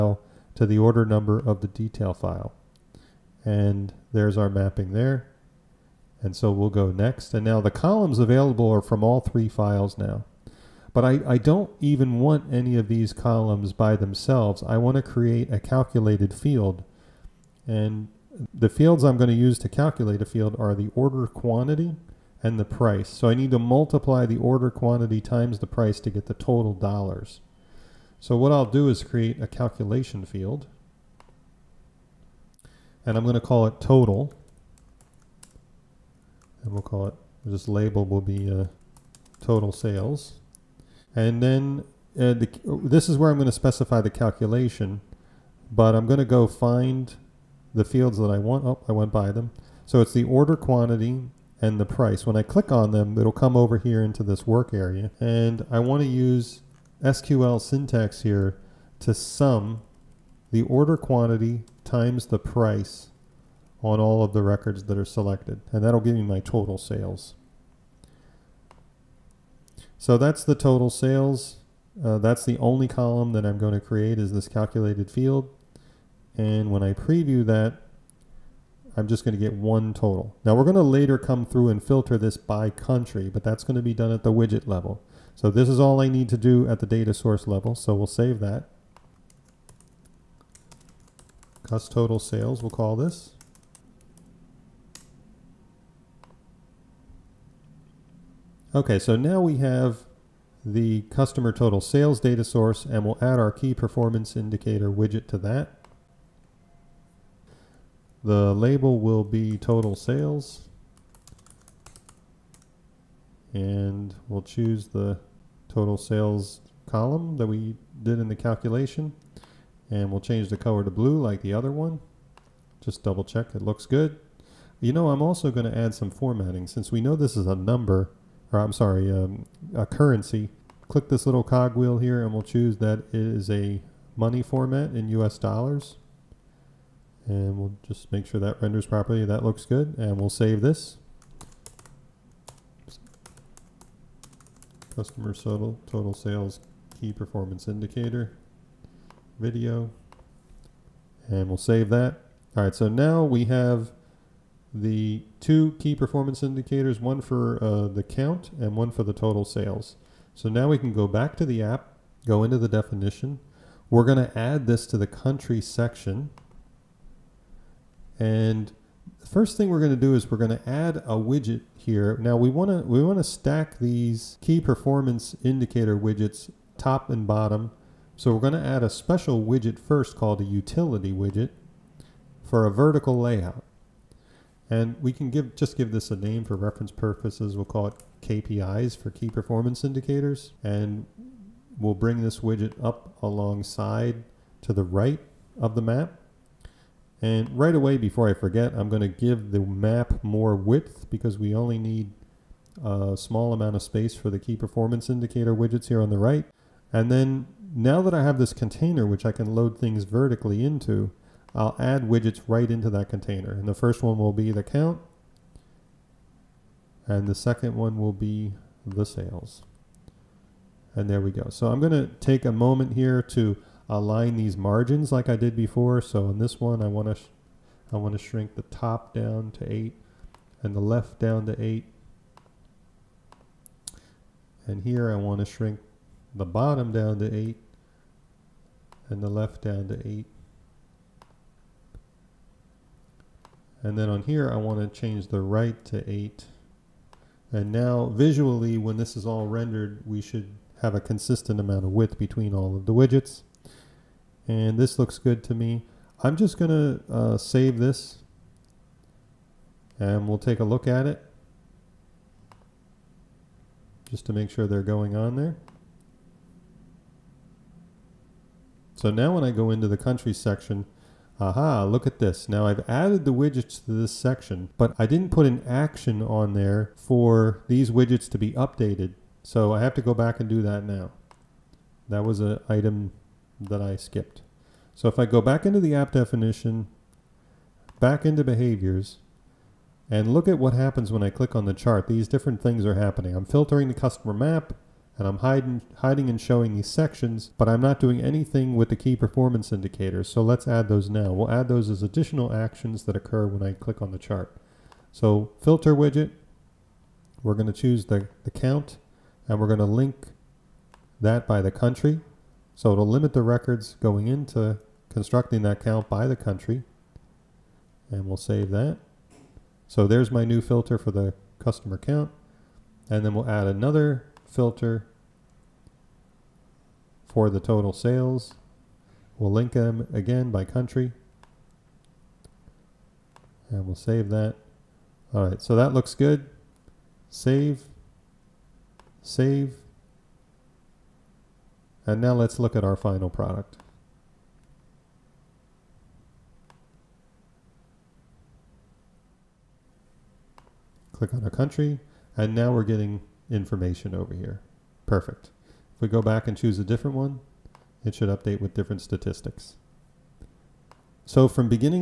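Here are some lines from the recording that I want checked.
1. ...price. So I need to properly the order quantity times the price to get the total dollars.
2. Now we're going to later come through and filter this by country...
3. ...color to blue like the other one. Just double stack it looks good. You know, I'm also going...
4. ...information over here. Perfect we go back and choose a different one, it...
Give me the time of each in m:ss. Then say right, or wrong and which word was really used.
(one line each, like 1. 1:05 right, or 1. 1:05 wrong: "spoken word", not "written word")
1. 0:22 wrong: "multiply", not "properly"
2. 1:20 right
3. 2:00 wrong: "check", not "stack"
4. 5:53 right.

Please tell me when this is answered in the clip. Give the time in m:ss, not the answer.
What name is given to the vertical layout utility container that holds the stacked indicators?
3:08.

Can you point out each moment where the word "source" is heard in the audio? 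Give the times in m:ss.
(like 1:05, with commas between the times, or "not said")
1:27, 1:42.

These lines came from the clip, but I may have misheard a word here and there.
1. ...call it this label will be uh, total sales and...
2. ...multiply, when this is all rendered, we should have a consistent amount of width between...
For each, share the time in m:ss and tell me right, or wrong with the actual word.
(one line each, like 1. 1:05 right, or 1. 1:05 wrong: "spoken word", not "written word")
1. 0:36 right
2. 4:08 wrong: "visually", not "multiply".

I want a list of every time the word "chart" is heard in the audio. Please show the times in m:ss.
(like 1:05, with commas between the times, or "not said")
4:51, 5:04.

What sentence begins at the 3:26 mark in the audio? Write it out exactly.
And then now that I have this container, which I can load things vertically into, I'll add widgets right into that container.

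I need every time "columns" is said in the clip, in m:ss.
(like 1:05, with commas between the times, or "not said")
0:07, 0:13, 1:12, 1:56.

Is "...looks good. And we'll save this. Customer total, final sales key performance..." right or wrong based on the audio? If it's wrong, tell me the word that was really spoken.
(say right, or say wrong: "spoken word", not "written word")
wrong: "total", not "final".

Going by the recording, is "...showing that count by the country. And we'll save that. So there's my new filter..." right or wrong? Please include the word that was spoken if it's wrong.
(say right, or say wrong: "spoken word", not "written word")
wrong: "constructing", not "showing".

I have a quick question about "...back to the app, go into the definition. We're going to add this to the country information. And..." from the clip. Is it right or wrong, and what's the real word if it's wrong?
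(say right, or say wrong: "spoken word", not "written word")
wrong: "section", not "information".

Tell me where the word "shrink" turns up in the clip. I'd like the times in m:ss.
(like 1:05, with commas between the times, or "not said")
3:48, 3:55.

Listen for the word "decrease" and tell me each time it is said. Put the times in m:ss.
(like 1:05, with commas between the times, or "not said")
not said.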